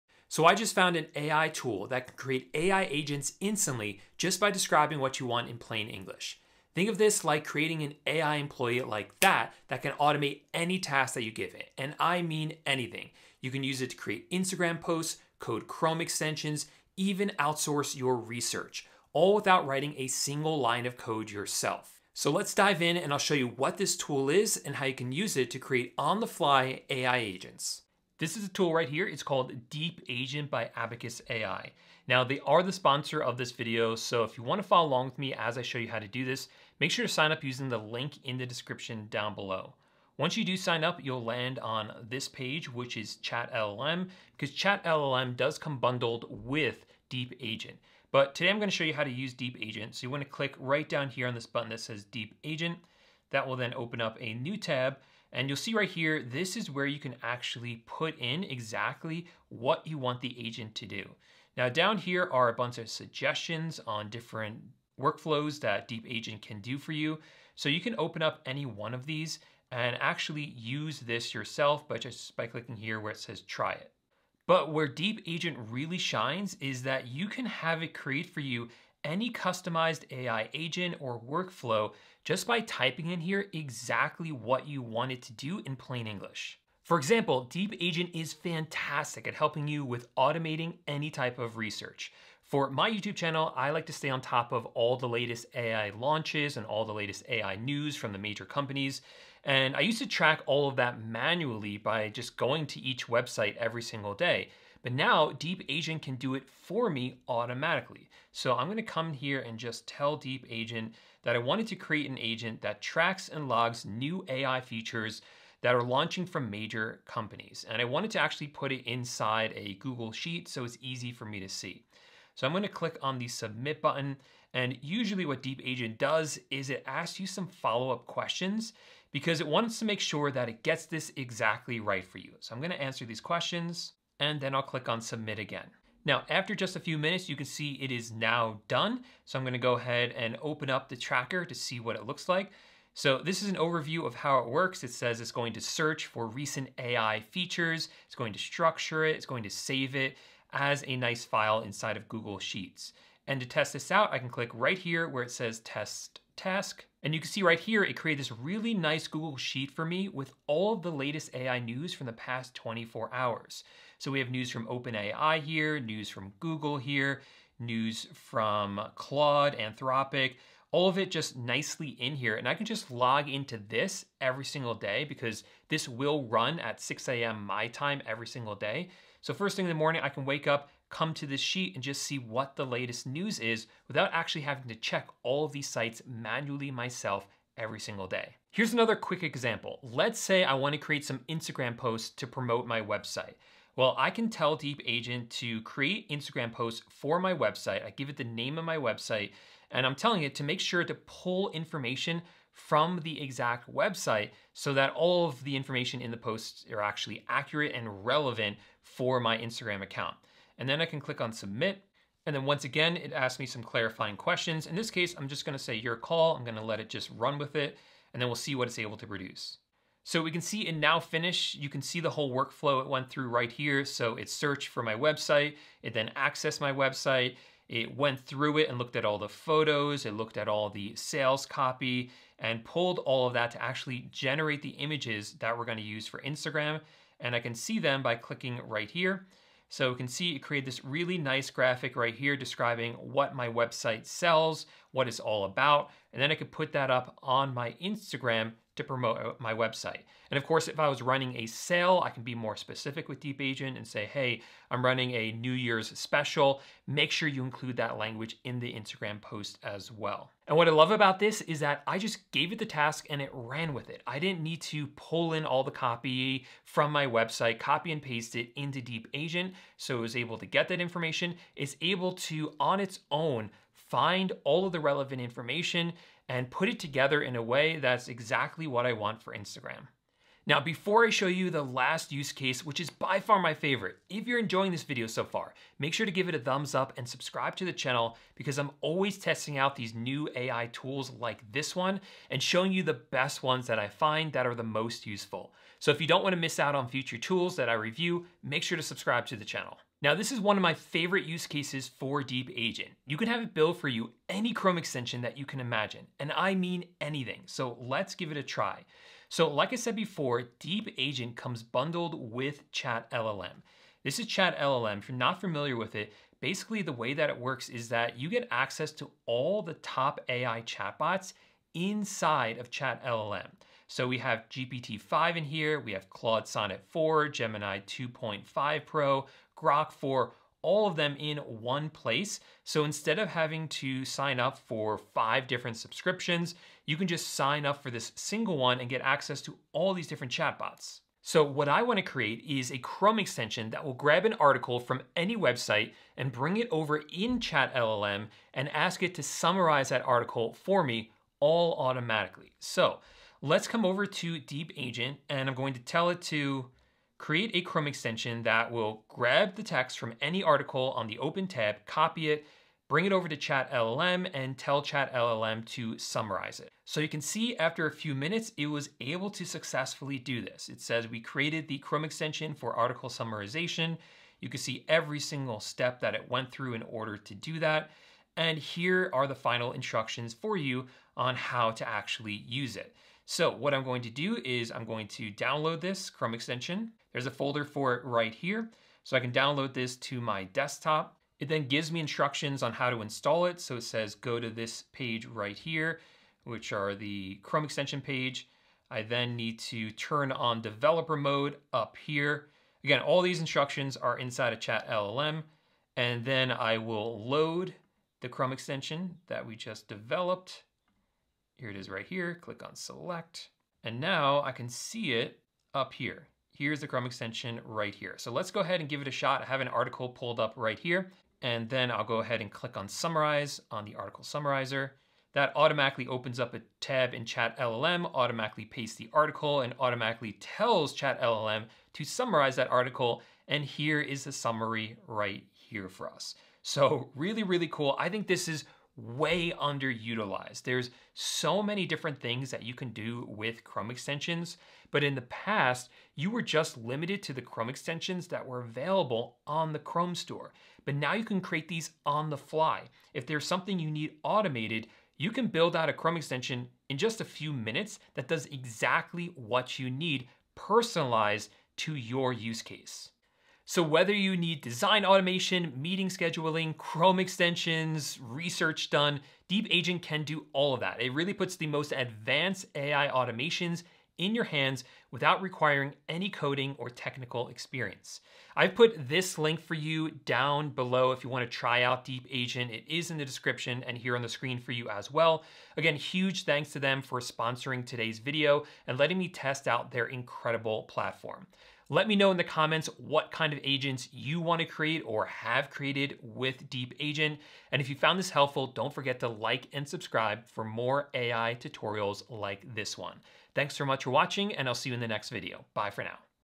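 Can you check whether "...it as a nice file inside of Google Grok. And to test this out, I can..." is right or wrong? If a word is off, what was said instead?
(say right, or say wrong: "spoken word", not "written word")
wrong: "Sheets", not "Grok".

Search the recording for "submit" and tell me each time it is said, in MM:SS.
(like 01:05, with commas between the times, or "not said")
02:03, 02:15, 03:31.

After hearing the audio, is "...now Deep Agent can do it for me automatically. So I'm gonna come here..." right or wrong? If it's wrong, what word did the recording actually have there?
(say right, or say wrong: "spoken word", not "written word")
right.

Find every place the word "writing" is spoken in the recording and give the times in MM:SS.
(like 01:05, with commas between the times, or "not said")
00:19.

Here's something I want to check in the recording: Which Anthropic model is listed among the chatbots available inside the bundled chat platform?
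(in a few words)
Claude Sonnet 4.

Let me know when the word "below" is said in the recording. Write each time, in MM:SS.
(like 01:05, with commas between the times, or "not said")
00:39, 08:00.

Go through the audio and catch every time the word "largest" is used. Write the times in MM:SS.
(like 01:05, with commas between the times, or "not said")
not said.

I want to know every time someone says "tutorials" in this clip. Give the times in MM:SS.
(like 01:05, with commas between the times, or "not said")
08:21.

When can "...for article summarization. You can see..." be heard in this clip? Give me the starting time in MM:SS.
06:12.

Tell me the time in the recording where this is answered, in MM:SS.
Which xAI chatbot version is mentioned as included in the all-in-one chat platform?
05:29.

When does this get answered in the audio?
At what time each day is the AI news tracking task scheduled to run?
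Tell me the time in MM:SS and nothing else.
02:56.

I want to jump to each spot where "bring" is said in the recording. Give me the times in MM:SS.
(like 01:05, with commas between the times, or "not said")
05:46, 06:02.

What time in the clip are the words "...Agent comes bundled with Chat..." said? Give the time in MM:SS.
05:10.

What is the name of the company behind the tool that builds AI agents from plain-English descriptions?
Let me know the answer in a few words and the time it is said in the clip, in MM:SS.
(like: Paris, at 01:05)
Abacus AI, at 00:30.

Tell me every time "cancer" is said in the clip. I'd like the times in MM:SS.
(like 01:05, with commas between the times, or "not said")
not said.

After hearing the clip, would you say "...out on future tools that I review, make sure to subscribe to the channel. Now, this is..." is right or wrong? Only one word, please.
right.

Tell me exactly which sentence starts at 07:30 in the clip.
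But now you can create these on the fly.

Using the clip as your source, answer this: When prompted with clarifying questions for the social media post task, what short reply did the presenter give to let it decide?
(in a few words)
your call.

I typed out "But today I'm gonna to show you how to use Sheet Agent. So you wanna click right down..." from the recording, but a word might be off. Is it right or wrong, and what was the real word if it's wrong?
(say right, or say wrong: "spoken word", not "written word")
wrong: "Deep", not "Sheet".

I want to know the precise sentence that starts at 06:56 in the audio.
Here's the Chrome extension right here.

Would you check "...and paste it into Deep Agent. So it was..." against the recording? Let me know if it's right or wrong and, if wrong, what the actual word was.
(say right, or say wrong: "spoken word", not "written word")
right.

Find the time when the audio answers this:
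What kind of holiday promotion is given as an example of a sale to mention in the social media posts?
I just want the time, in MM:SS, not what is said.
04:15.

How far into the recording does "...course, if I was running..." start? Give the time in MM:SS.
04:10.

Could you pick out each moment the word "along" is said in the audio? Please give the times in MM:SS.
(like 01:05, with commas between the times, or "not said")
00:34.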